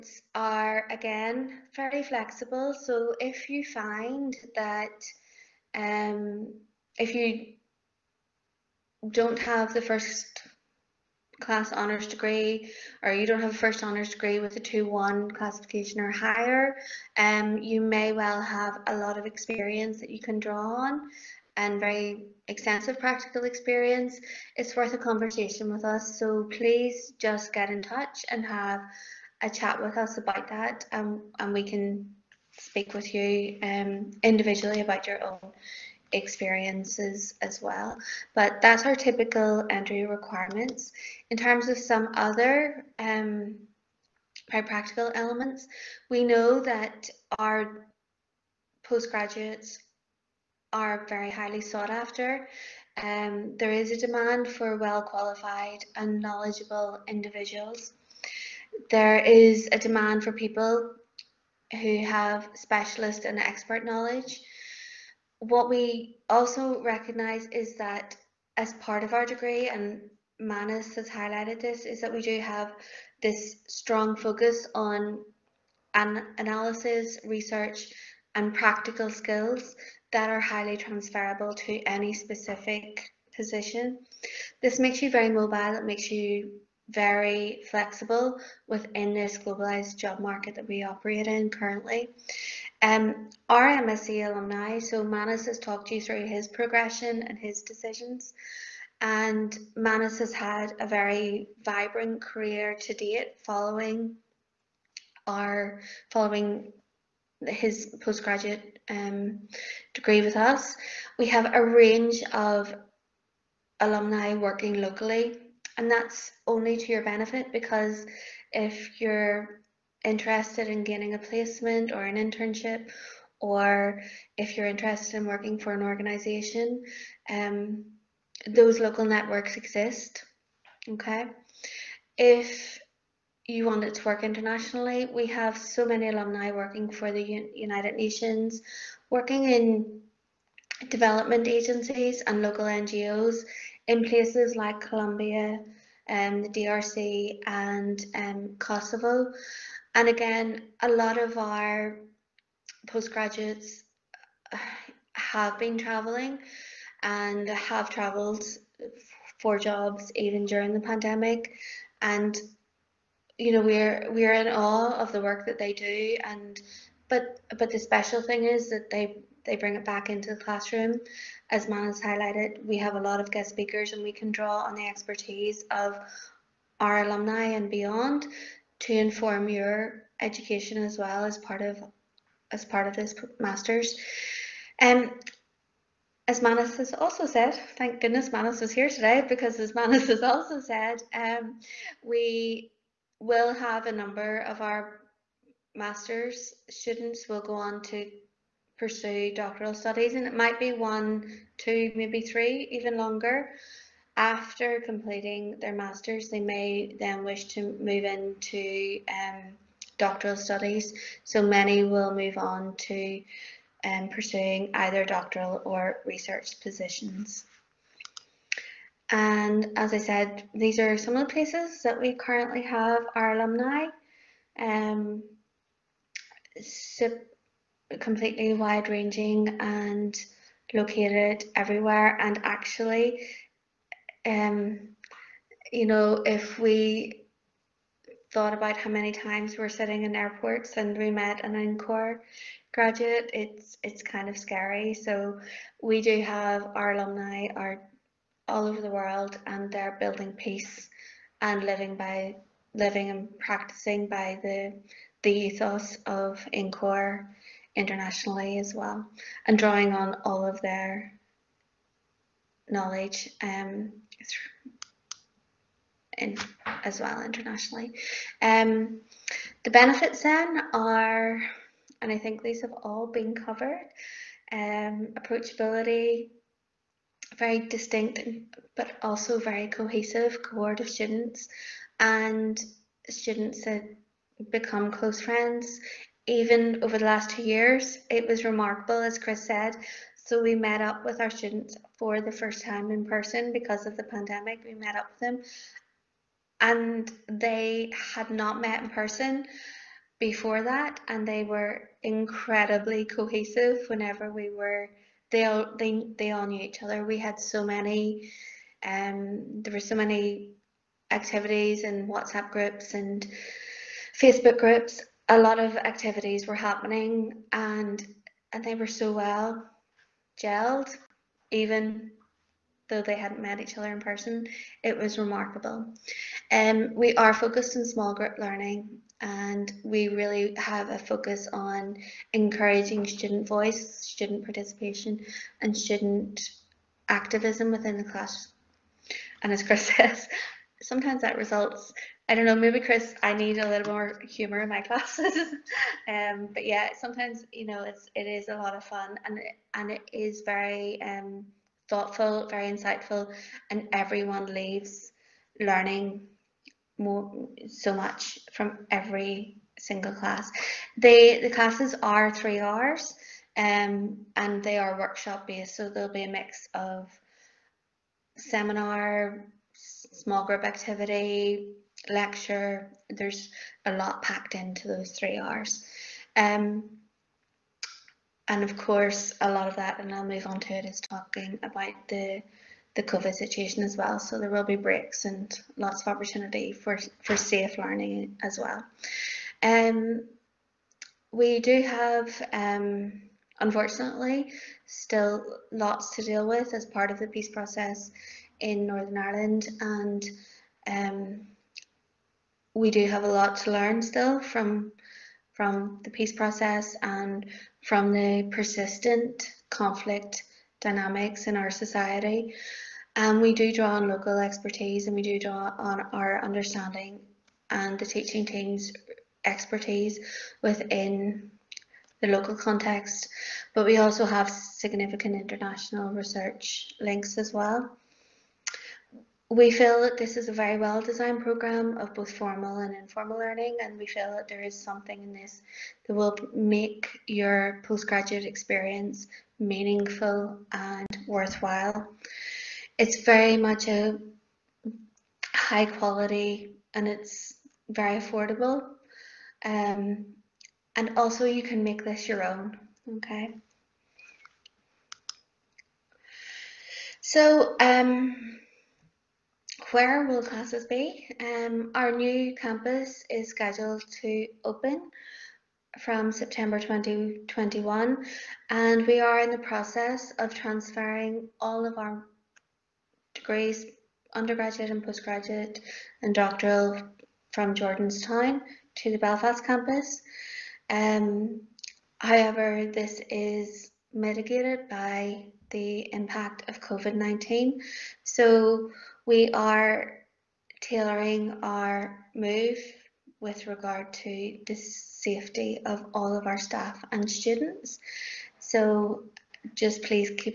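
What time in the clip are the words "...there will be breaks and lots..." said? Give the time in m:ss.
6:24.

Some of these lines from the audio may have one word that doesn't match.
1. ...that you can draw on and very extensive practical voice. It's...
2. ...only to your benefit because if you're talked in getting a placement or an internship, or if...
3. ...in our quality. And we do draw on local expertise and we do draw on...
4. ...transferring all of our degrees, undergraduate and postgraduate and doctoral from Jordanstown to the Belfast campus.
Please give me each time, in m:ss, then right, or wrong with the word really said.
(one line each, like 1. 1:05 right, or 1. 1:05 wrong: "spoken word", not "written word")
1. 0:19 wrong: "experience", not "voice"
2. 1:56 wrong: "interested", not "talked"
3. 6:51 wrong: "society", not "quality"
4. 7:50 right.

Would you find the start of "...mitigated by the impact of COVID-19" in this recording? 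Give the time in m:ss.
8:04.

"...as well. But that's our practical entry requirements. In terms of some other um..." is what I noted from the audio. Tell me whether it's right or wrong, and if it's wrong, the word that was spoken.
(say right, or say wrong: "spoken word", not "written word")
wrong: "typical", not "practical".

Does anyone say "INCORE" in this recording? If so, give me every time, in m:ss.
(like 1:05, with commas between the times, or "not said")
4:01, 4:16.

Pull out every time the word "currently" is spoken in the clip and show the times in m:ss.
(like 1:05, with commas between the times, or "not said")
1:31, 3:42.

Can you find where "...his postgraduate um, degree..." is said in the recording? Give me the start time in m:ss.
1:47.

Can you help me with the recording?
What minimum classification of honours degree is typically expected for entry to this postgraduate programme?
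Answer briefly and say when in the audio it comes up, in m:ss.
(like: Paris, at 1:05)
2-1, at 0:14.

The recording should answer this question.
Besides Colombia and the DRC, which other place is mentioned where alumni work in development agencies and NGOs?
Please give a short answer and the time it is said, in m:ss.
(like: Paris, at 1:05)
Kosovo, at 2:28.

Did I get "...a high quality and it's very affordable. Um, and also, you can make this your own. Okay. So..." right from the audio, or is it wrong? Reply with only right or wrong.
right.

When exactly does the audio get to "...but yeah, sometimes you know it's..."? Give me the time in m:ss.
5:46.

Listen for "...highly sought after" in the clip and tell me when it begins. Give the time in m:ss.
0:51.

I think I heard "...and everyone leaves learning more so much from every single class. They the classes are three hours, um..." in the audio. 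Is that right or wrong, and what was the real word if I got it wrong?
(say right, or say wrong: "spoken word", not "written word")
right.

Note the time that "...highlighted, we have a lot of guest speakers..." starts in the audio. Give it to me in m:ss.
2:52.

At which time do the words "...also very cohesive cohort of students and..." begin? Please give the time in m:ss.
4:39.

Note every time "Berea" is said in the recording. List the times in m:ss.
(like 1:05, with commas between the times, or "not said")
not said.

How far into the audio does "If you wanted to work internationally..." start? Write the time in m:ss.
2:12.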